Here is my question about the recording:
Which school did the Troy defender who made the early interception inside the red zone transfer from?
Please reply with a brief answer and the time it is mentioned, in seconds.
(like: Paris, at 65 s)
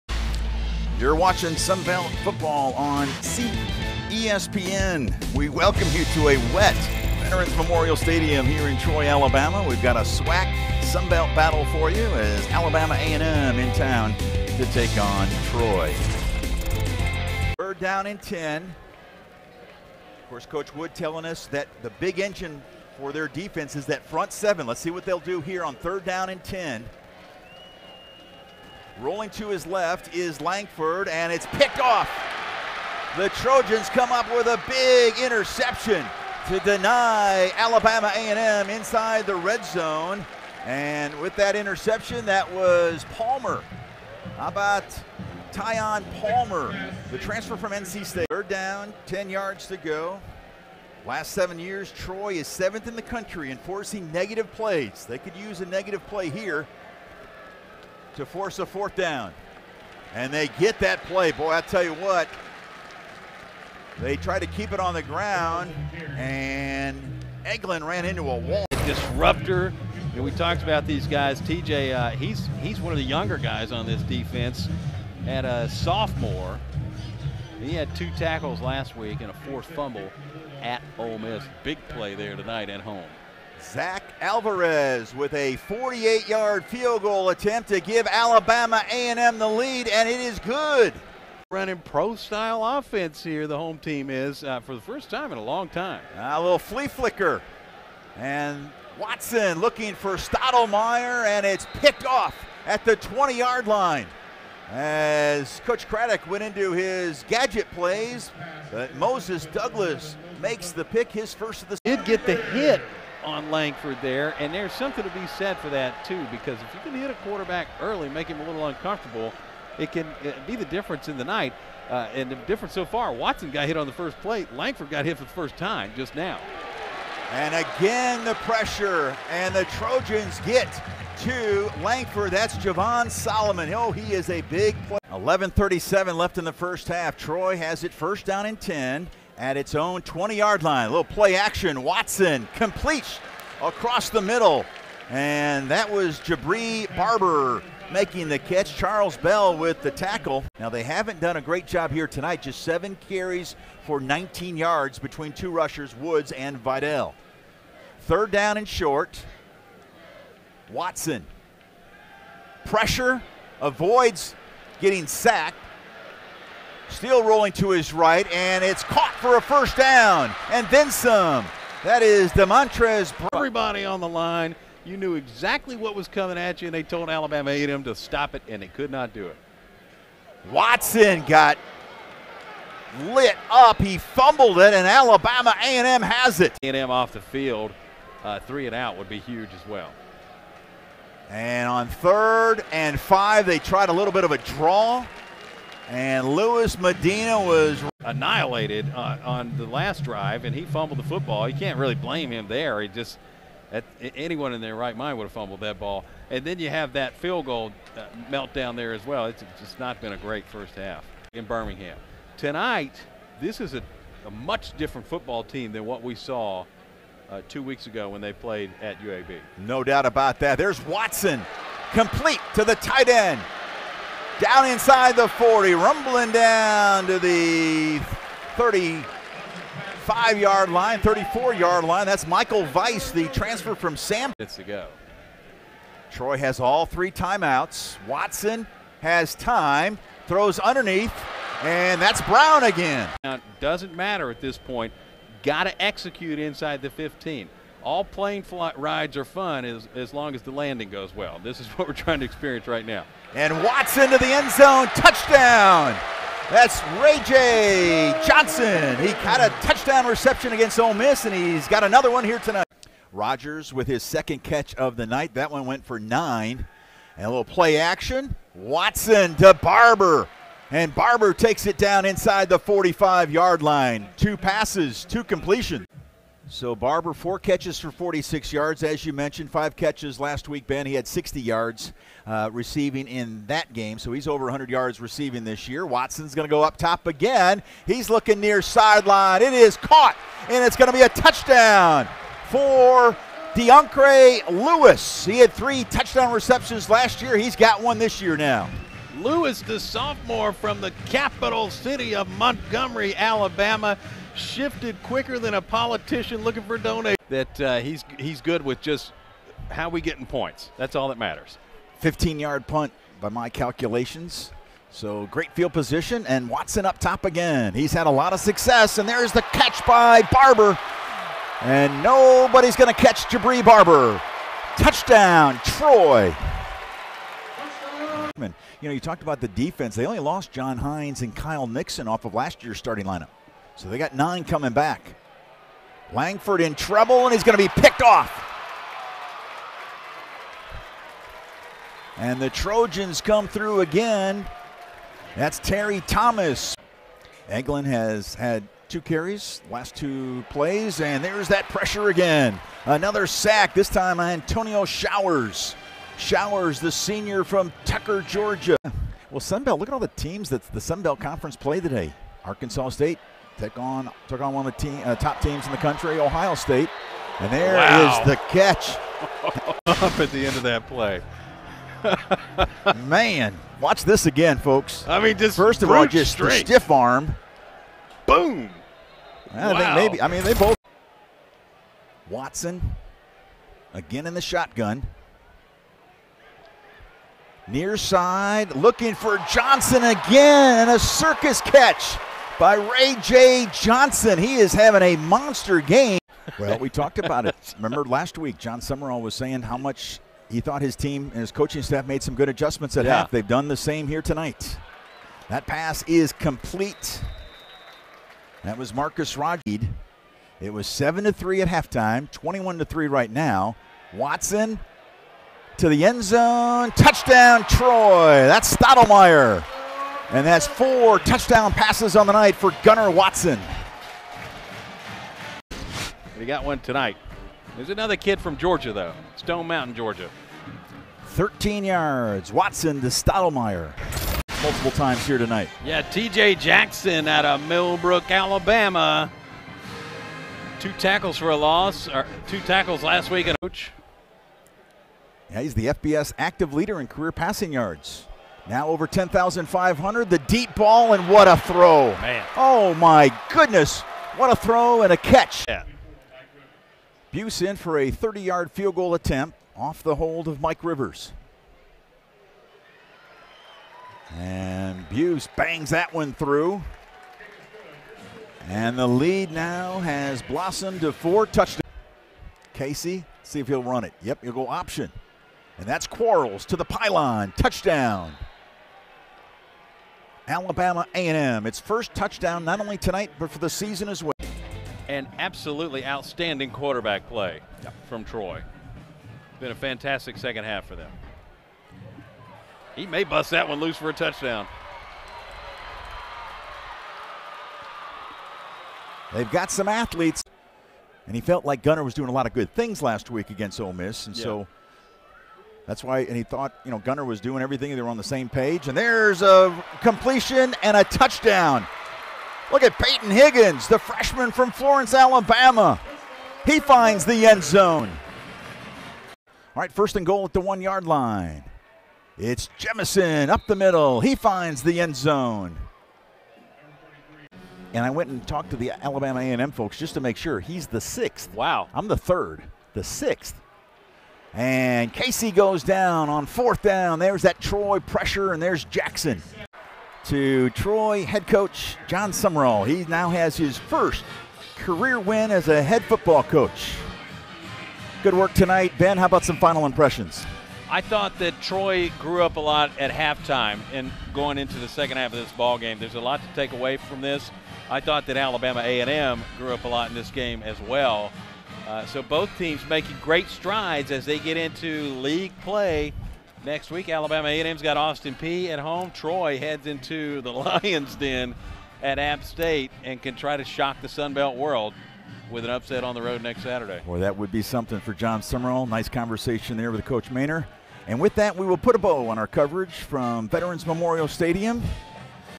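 NC State, at 47 s.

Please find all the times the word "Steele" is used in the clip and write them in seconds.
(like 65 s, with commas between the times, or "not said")
166 s.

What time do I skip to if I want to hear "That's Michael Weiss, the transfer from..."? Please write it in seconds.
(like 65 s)
232 s.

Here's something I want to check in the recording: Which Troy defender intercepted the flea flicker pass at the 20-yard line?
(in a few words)
Moses Douglas.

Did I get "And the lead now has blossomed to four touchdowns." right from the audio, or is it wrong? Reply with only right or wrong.
right.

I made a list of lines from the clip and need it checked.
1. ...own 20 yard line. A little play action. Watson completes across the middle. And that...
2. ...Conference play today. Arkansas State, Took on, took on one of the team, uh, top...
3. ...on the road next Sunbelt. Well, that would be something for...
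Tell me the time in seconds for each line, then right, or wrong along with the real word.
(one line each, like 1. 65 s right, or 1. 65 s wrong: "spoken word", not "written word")
1. 139 s right
2. 361 s right
3. 576 s wrong: "Saturday", not "Sunbelt".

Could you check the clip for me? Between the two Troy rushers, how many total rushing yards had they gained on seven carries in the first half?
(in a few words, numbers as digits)
19.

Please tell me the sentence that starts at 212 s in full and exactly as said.
Tonight, this is a, a much different football team than what we saw uh, two weeks ago when they played at UAB.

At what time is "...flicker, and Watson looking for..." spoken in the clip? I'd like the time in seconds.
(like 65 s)
96 s.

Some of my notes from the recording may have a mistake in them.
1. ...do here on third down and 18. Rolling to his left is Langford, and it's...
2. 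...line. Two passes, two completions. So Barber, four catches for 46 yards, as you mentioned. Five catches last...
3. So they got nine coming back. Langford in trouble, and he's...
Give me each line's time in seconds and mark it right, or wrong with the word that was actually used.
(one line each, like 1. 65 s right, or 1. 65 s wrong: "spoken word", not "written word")
1. 25 s wrong: "10", not "18"
2. 273 s right
3. 333 s right.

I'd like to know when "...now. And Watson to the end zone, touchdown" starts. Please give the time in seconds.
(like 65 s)
252 s.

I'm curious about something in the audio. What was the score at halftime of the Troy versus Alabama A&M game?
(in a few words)
7 to 3.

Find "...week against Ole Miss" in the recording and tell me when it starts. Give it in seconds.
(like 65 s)
503 s.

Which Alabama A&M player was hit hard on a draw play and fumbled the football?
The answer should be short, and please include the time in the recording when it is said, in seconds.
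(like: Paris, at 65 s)
Lewis Medina, at 196 s.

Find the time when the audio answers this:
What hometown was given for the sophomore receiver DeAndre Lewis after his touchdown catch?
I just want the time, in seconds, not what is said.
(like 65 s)
302 s.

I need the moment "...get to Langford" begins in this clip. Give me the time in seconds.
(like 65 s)
130 s.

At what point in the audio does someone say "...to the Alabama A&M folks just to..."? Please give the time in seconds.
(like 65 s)
528 s.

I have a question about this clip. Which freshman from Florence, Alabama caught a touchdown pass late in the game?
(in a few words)
Peyton Higgins.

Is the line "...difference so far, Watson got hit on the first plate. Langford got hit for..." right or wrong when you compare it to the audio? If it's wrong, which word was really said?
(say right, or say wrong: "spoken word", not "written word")
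right.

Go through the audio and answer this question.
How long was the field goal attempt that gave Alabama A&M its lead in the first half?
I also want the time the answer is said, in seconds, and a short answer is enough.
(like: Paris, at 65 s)
48 yards, at 85 s.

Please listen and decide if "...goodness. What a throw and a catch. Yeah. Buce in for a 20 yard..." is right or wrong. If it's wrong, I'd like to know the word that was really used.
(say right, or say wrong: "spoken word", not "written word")
wrong: "30", not "20".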